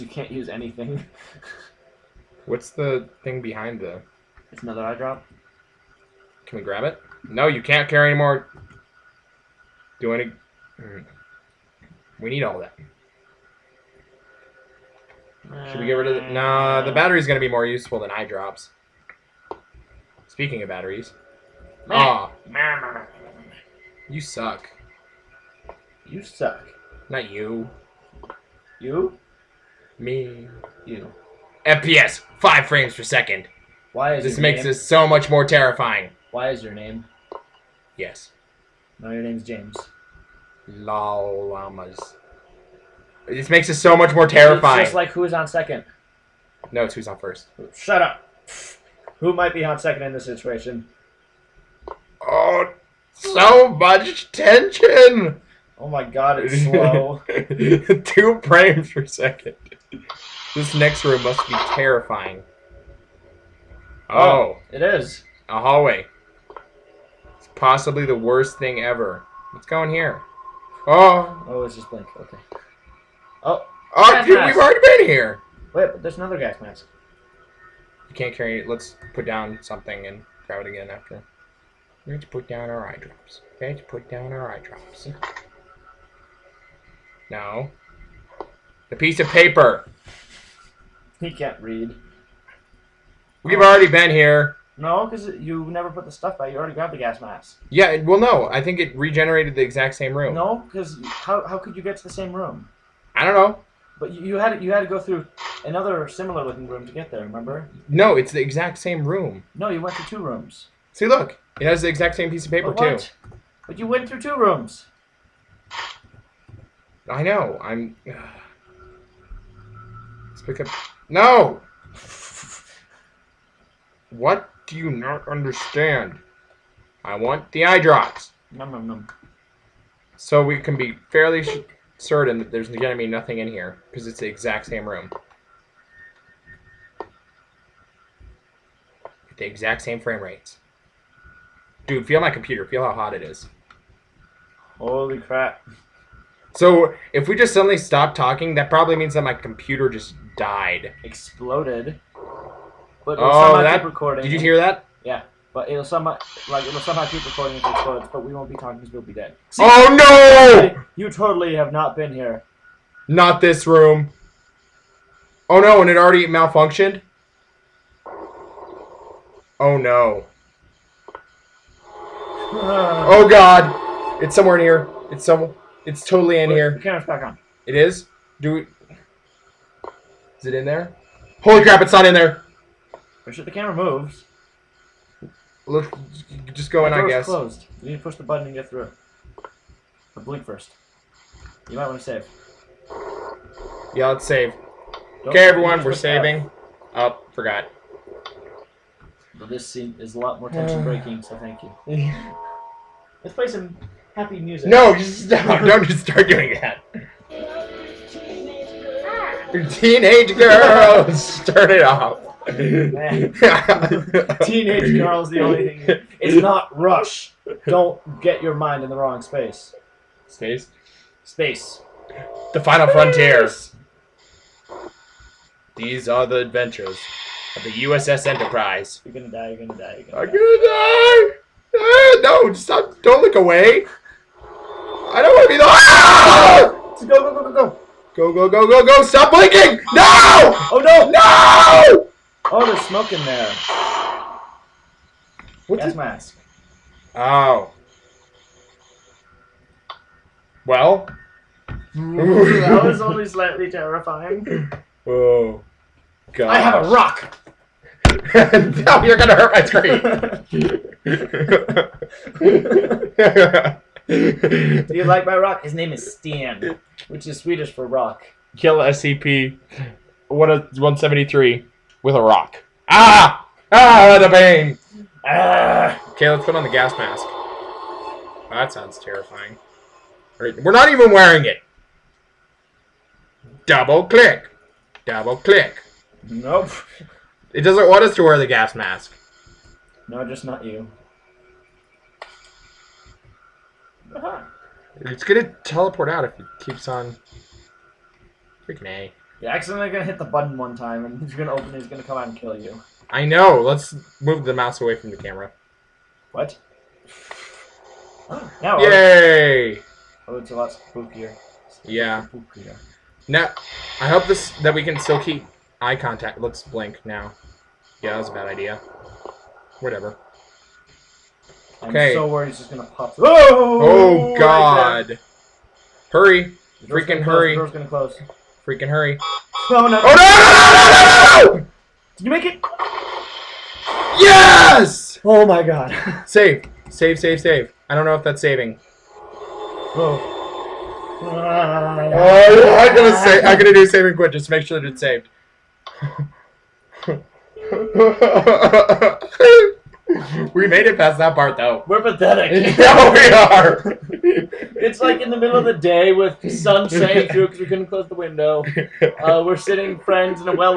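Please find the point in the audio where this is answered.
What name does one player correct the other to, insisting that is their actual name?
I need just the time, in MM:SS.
00:39.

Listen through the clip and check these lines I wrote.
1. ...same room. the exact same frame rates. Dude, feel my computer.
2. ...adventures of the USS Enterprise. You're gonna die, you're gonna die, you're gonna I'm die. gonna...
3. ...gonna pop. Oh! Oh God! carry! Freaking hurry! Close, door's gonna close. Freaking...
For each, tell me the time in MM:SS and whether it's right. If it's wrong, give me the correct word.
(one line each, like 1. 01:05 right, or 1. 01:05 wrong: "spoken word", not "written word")
1. 02:14 right
2. 03:46 right
3. 05:22 wrong: "hurry", not "carry".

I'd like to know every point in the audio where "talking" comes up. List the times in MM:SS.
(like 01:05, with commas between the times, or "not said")
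02:28, 02:38.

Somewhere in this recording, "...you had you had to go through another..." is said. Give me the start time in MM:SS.
01:44.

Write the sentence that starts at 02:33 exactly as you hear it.
But it'll oh, somehow that, keep recording.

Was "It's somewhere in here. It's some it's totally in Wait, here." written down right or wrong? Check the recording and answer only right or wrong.
right.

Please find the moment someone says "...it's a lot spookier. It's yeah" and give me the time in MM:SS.
05:10.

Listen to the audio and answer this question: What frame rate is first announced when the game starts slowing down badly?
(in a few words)
5 frames per second.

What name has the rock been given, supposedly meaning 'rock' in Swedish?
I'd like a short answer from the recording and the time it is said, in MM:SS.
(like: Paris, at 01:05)
Stan, at 04:26.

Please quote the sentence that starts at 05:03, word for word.
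Let's move the mouse away from the camera.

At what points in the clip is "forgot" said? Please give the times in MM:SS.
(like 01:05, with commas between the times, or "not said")
03:17.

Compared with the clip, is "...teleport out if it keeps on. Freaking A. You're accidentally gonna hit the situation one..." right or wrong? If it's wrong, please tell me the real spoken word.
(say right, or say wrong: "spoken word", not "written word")
wrong: "button", not "situation".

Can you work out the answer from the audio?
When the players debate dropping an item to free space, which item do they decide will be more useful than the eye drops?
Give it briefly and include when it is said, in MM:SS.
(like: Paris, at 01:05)
battery, at 00:16.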